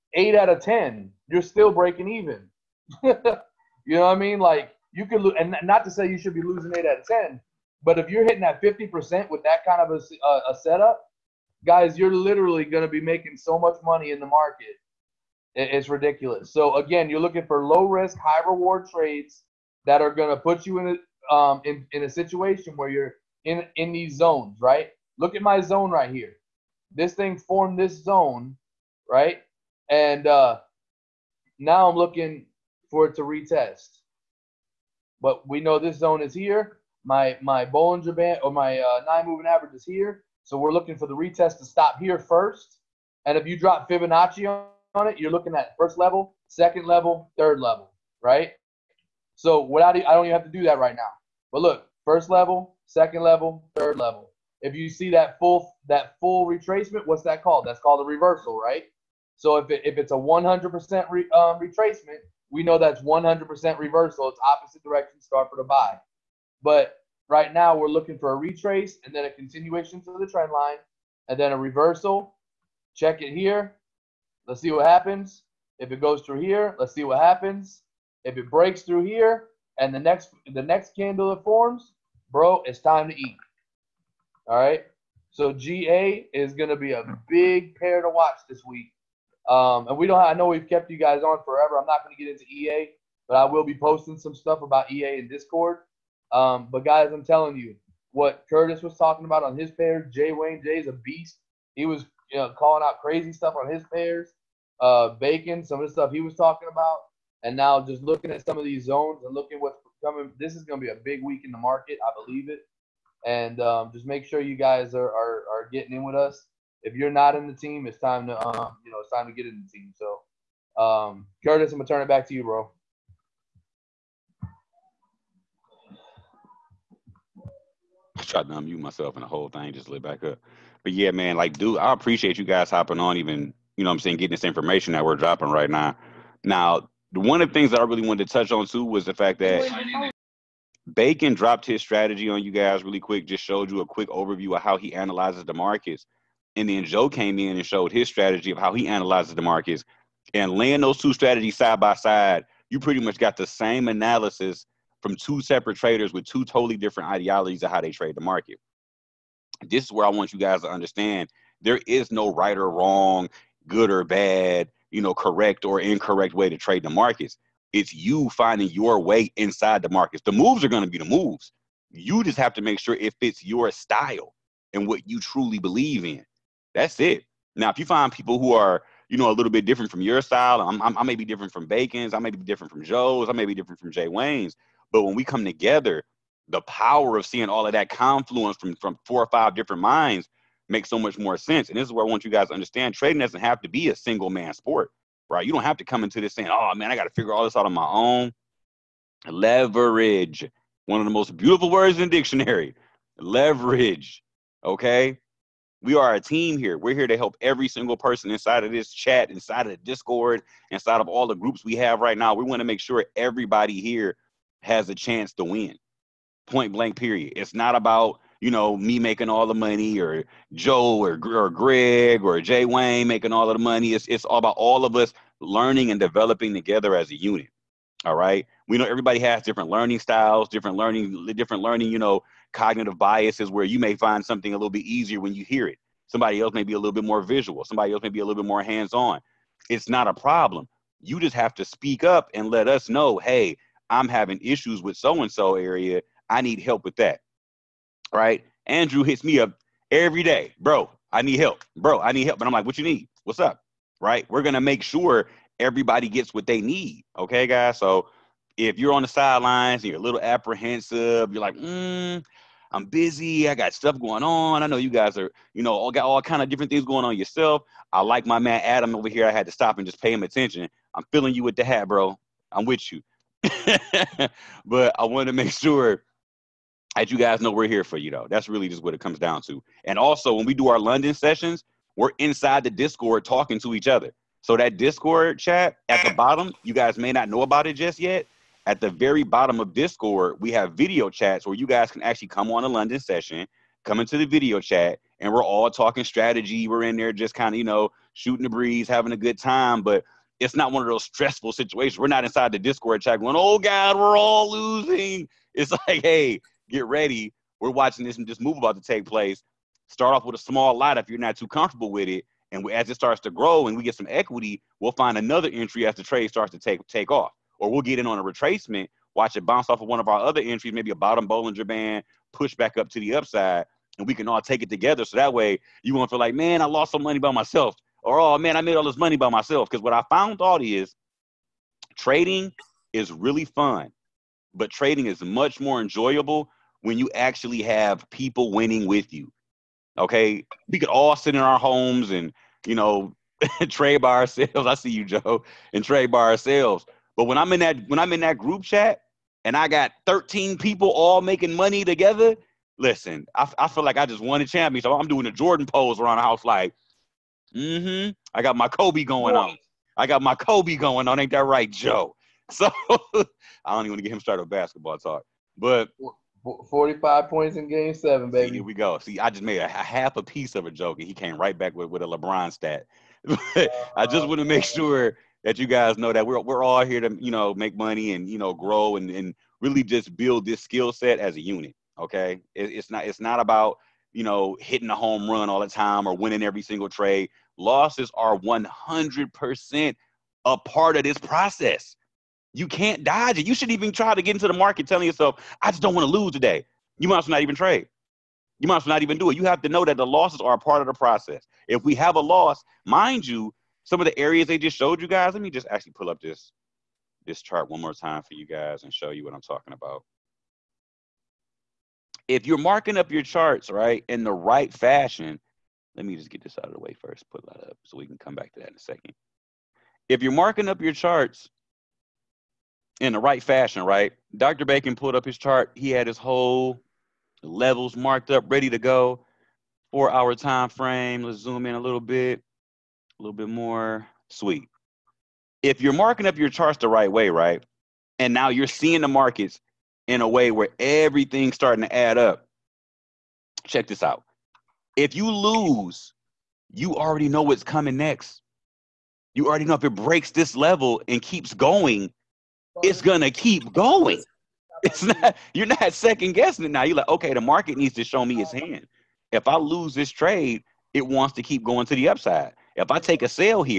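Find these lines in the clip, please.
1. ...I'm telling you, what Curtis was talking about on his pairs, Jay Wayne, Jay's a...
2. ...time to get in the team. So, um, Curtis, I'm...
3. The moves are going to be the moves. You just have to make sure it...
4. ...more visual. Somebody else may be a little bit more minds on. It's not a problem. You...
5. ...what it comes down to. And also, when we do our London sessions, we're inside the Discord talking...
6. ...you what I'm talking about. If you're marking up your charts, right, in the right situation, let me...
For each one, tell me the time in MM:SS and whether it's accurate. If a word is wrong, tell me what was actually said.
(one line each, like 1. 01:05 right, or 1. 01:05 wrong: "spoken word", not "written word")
1. 01:37 right
2. 01:59 right
3. 02:50 right
4. 03:57 wrong: "hands", not "minds"
5. 04:38 right
6. 06:49 wrong: "fashion", not "situation".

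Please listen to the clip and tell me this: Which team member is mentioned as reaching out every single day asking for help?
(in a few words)
Andrew.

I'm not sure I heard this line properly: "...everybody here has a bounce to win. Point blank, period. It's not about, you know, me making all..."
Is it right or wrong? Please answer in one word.
wrong.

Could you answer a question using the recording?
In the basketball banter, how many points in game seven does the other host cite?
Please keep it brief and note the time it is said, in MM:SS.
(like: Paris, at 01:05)
45, at 06:06.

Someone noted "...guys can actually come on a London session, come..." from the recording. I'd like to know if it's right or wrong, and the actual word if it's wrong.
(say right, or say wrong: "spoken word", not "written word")
right.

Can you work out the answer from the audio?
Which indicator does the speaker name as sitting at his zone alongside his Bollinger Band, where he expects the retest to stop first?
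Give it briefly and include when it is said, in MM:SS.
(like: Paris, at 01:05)
9 moving average, at 00:39.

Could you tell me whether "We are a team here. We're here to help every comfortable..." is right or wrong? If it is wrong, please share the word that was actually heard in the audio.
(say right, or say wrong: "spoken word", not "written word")
wrong: "single", not "comfortable".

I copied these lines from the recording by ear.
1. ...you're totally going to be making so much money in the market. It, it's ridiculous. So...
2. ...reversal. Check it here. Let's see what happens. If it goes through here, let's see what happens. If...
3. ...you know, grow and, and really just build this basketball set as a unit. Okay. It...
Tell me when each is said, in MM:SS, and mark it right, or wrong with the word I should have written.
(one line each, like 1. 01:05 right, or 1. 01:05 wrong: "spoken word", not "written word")
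1. 00:11 wrong: "literally", not "totally"
2. 01:11 right
3. 06:18 wrong: "skill", not "basketball".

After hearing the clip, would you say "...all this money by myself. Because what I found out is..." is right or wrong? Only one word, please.
right.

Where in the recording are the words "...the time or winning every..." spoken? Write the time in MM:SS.
06:25.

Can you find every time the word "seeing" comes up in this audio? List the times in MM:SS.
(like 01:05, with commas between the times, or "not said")
03:07, 07:18.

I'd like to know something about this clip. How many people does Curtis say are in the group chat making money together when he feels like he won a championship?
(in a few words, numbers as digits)
13.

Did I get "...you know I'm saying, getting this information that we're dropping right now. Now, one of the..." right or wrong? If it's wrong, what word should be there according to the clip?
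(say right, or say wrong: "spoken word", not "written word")
right.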